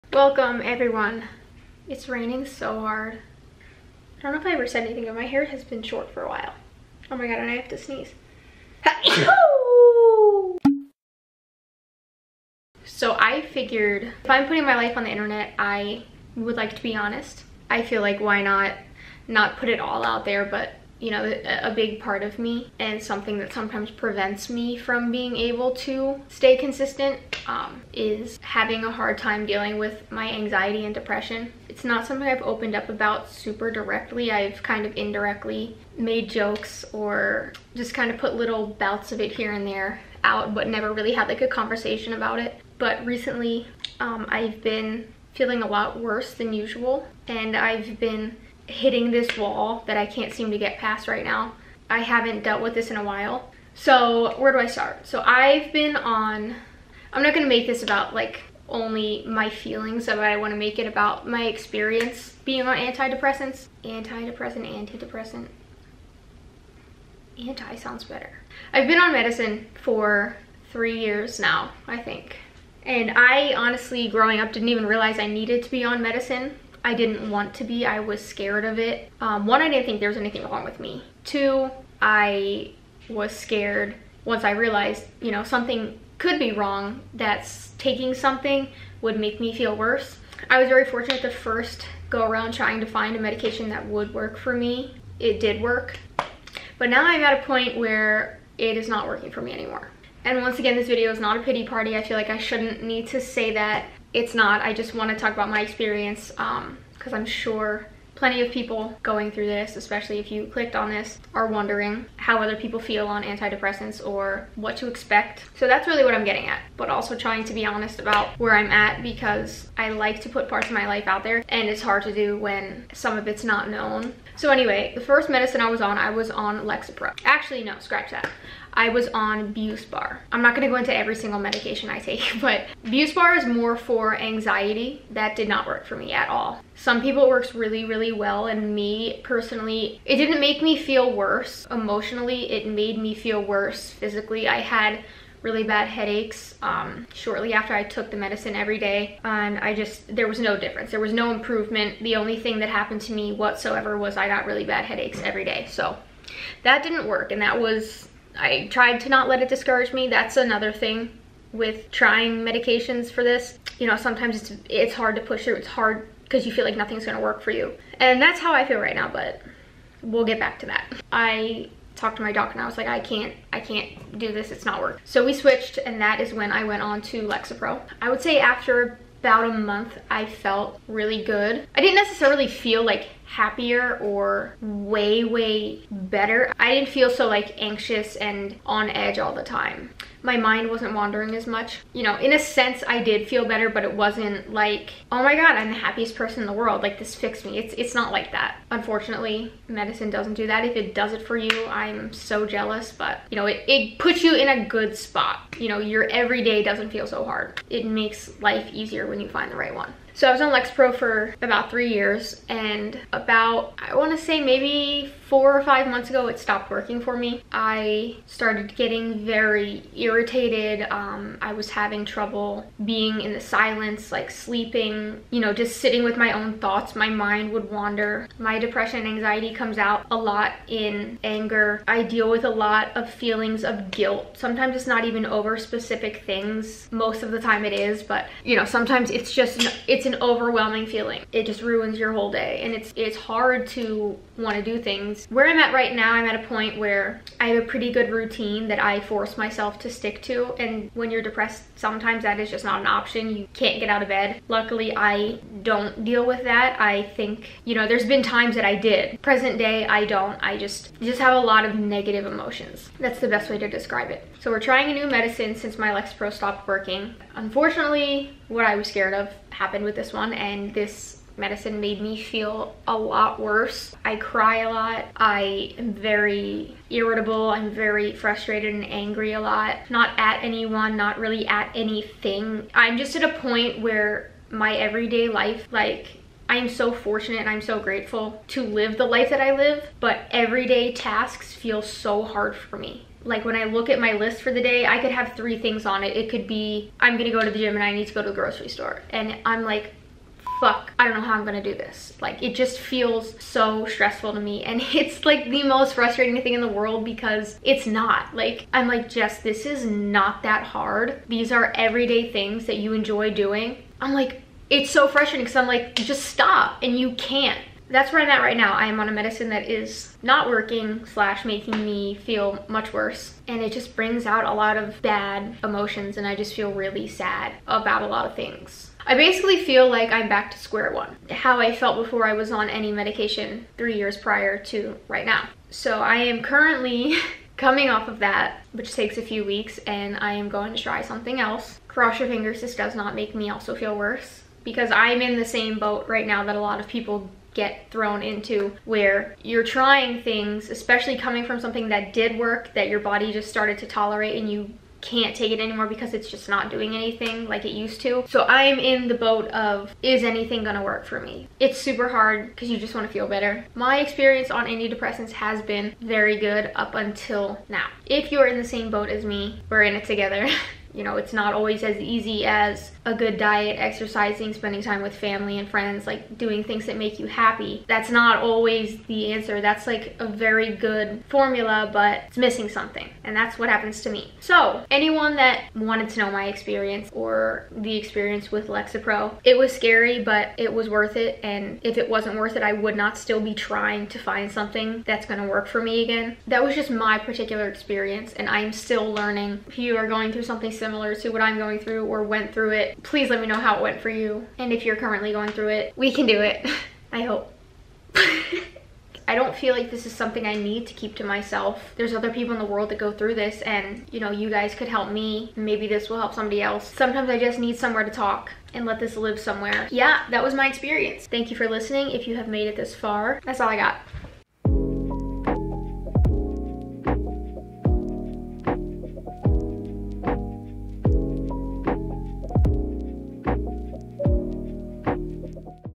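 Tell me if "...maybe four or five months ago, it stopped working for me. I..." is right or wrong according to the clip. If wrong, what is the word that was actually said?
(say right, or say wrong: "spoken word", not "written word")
right.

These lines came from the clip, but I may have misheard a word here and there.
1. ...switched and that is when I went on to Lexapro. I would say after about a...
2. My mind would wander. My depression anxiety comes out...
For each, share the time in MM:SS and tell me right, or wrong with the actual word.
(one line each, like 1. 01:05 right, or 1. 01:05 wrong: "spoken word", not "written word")
1. 02:55 right
2. 03:46 right.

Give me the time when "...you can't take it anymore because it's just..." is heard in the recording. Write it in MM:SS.
05:54.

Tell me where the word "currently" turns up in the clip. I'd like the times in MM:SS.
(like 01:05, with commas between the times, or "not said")
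05:36, 06:44.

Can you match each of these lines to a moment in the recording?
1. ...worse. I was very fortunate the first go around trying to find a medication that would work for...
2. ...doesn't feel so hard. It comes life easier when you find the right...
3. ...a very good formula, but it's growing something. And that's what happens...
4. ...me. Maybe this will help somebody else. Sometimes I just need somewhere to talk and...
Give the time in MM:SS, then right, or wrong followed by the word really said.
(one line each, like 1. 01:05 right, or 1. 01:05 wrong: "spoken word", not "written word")
1. 01:29 right
2. 03:26 wrong: "makes", not "comes"
3. 06:20 wrong: "missing", not "growing"
4. 06:55 right.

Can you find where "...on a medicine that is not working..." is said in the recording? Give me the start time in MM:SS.
05:19.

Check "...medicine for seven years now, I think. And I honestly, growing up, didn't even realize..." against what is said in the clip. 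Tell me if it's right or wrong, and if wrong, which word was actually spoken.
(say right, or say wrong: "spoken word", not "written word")
wrong: "three", not "seven".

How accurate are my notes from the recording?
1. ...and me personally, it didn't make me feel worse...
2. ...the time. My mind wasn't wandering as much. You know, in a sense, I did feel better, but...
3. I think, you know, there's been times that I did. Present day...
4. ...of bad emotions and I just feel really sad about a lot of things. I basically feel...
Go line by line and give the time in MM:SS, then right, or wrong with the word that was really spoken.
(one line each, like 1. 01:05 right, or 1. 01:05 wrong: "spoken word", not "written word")
1. 02:18 right
2. 03:09 right
3. 04:16 right
4. 05:24 right.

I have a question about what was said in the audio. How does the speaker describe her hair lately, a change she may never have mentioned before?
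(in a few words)
short.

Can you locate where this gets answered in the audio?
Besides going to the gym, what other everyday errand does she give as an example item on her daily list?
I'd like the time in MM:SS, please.
04:58.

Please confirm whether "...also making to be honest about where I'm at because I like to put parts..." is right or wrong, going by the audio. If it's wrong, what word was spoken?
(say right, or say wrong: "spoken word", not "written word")
wrong: "trying", not "making".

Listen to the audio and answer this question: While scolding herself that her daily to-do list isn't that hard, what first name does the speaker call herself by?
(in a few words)
Jess.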